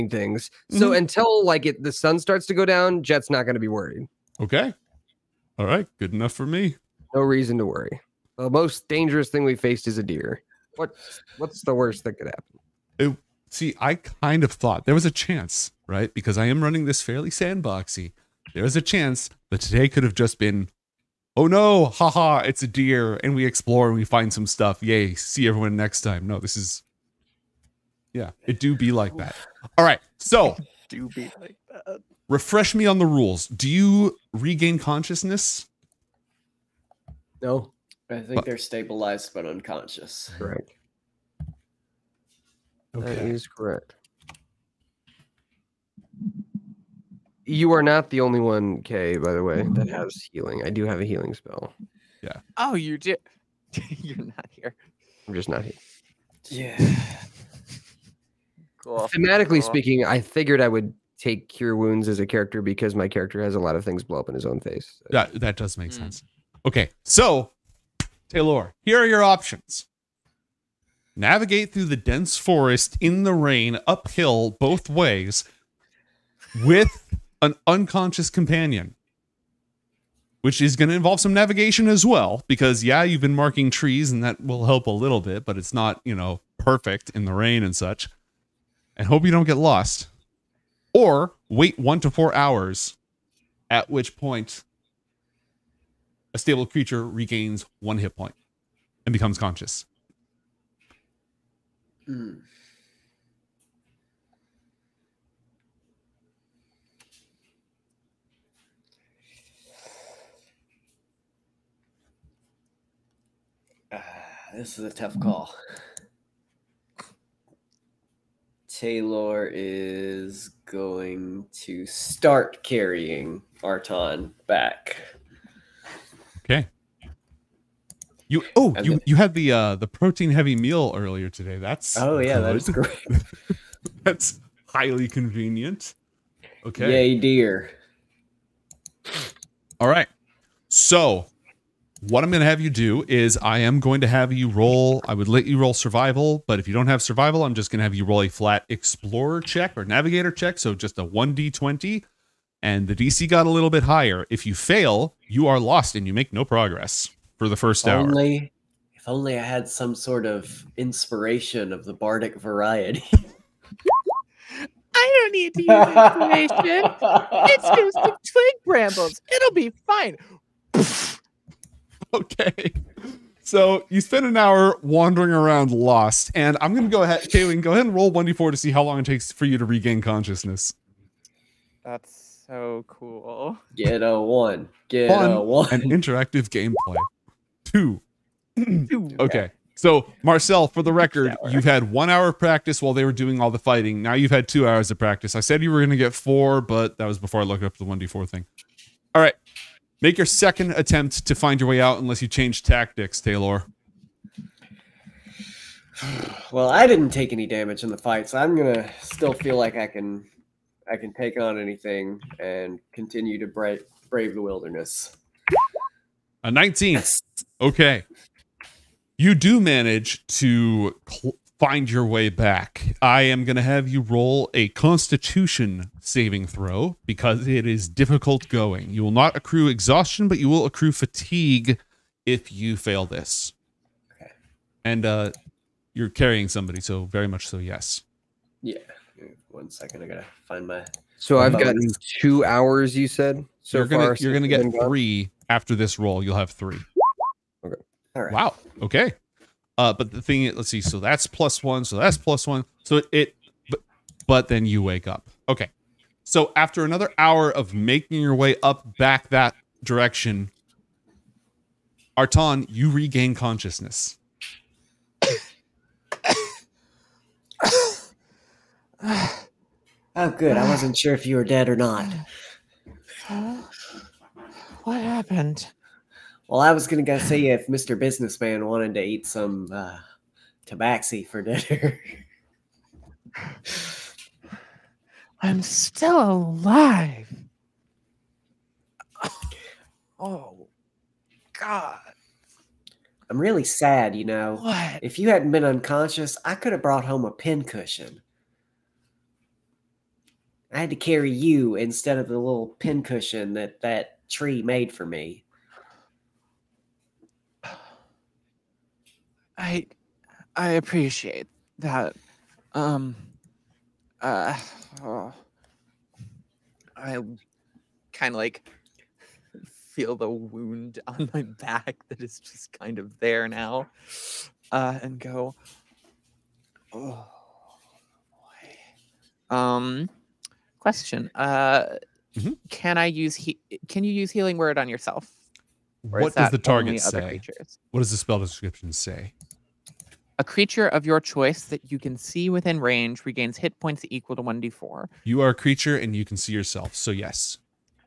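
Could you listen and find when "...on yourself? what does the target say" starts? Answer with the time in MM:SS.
05:34.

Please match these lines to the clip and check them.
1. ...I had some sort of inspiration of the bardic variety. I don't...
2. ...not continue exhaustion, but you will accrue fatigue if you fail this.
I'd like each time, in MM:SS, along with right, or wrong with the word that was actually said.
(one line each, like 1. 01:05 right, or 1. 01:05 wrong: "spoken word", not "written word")
1. 02:39 right
2. 03:49 wrong: "accrue", not "continue".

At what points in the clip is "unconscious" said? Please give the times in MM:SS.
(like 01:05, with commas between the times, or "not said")
00:39, 01:17, 04:55.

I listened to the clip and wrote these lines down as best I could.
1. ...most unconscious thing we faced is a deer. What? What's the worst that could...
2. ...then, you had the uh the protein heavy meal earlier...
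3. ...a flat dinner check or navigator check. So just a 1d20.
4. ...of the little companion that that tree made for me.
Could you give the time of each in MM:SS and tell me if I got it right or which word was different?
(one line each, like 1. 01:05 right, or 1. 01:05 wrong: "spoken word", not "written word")
1. 00:08 wrong: "dangerous", not "unconscious"
2. 02:08 right
3. 02:28 wrong: "explorer", not "dinner"
4. 05:02 wrong: "pincushion", not "companion".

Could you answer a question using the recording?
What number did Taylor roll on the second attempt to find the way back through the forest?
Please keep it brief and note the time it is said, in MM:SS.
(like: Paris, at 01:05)
19, at 03:36.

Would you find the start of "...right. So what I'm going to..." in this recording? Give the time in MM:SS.
02:19.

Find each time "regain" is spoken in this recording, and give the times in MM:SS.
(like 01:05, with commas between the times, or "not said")
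00:34, 01:37, 02:59, 04:22, 05:43.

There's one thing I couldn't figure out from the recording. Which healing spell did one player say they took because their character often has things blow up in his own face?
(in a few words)
cure wounds.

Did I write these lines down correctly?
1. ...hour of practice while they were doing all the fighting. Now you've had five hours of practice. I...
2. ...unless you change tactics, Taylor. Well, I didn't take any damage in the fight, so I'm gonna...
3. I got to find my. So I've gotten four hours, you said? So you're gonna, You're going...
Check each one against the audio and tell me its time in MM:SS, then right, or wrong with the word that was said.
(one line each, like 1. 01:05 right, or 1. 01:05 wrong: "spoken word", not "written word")
1. 03:12 wrong: "two", not "five"
2. 03:21 right
3. 04:00 wrong: "two", not "four".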